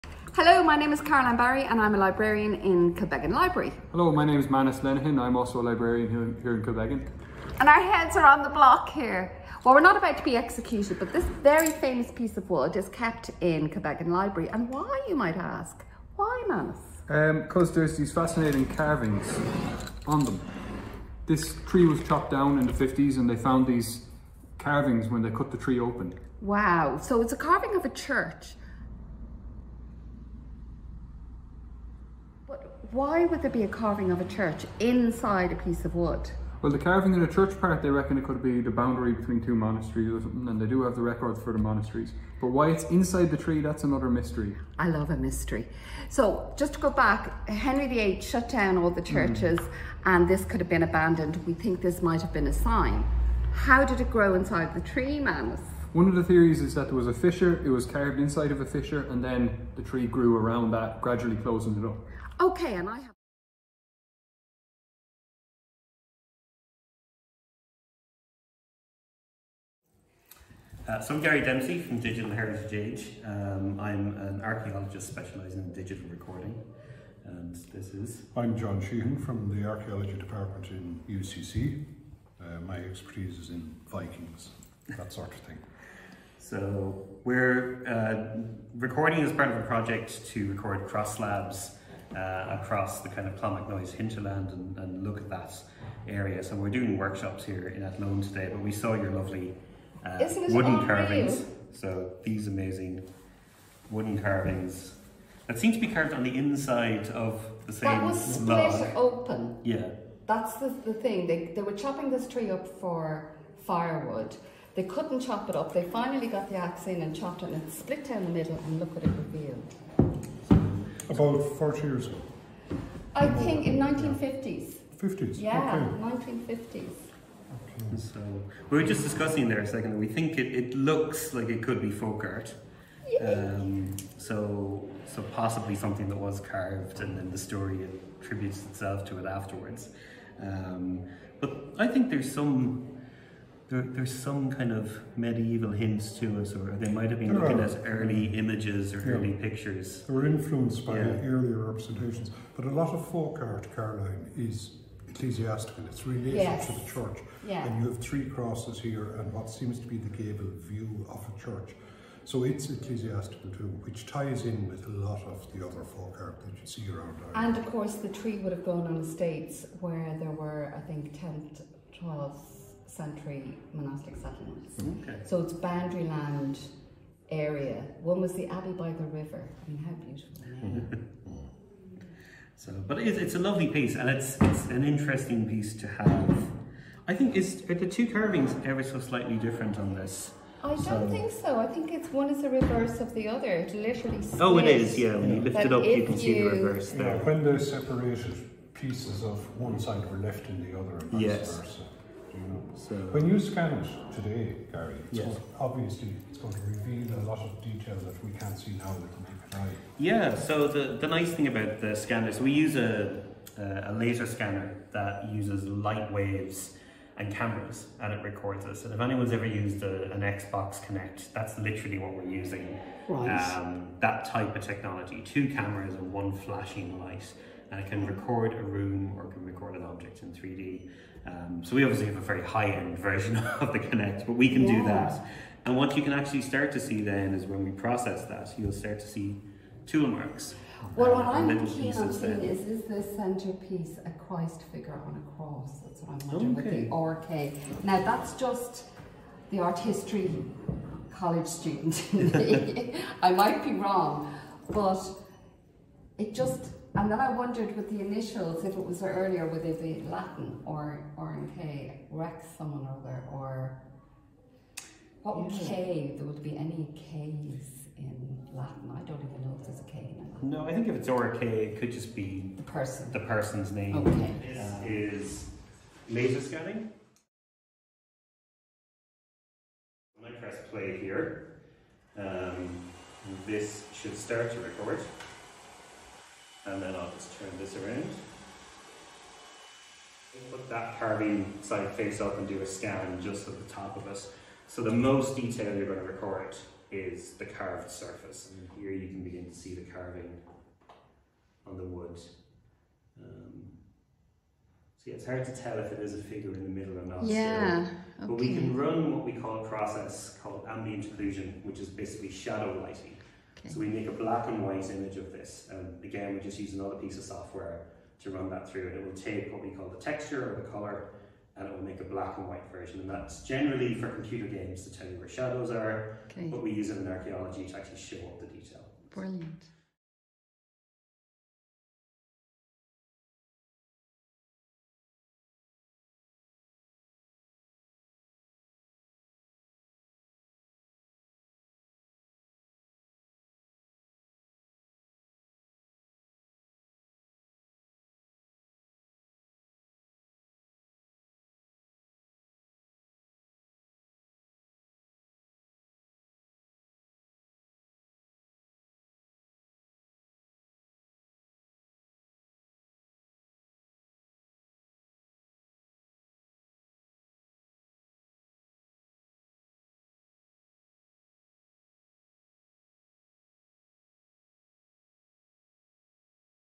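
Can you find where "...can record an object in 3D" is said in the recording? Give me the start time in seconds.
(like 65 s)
229 s.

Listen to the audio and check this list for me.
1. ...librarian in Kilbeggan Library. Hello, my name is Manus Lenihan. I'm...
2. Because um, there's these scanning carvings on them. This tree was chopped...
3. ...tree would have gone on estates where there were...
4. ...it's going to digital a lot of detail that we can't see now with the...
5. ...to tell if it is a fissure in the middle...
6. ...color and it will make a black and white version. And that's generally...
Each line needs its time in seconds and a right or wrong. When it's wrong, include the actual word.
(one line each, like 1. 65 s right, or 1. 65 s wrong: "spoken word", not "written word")
1. 1 s right
2. 17 s wrong: "fascinating", not "scanning"
3. 168 s right
4. 206 s wrong: "reveal", not "digital"
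5. 305 s wrong: "figure", not "fissure"
6. 320 s right.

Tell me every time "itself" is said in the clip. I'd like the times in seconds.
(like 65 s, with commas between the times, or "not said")
138 s.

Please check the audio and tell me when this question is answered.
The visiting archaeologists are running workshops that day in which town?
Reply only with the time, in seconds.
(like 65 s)
97 s.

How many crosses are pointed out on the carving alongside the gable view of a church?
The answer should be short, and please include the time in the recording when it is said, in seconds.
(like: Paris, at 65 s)
3, at 157 s.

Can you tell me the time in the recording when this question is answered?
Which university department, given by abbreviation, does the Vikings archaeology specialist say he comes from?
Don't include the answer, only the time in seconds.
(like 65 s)
81 s.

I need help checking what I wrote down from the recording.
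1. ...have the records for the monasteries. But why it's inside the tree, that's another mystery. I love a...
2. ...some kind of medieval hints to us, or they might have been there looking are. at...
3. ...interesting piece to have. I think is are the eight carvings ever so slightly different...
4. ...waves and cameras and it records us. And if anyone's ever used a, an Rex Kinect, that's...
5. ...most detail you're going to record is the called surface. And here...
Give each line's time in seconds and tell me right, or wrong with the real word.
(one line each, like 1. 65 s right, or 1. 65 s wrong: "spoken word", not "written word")
1. 40 s right
2. 144 s right
3. 184 s wrong: "two", not "eight"
4. 216 s wrong: "Xbox", not "Rex"
5. 294 s wrong: "carved", not "called".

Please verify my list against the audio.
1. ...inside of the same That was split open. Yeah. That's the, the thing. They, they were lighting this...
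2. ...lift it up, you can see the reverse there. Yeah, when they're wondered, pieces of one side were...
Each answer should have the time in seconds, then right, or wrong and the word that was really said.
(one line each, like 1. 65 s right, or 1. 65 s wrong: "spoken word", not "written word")
1. 106 s wrong: "chopping", not "lighting"
2. 195 s wrong: "separated", not "wondered".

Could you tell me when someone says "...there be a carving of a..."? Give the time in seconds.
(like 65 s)
33 s.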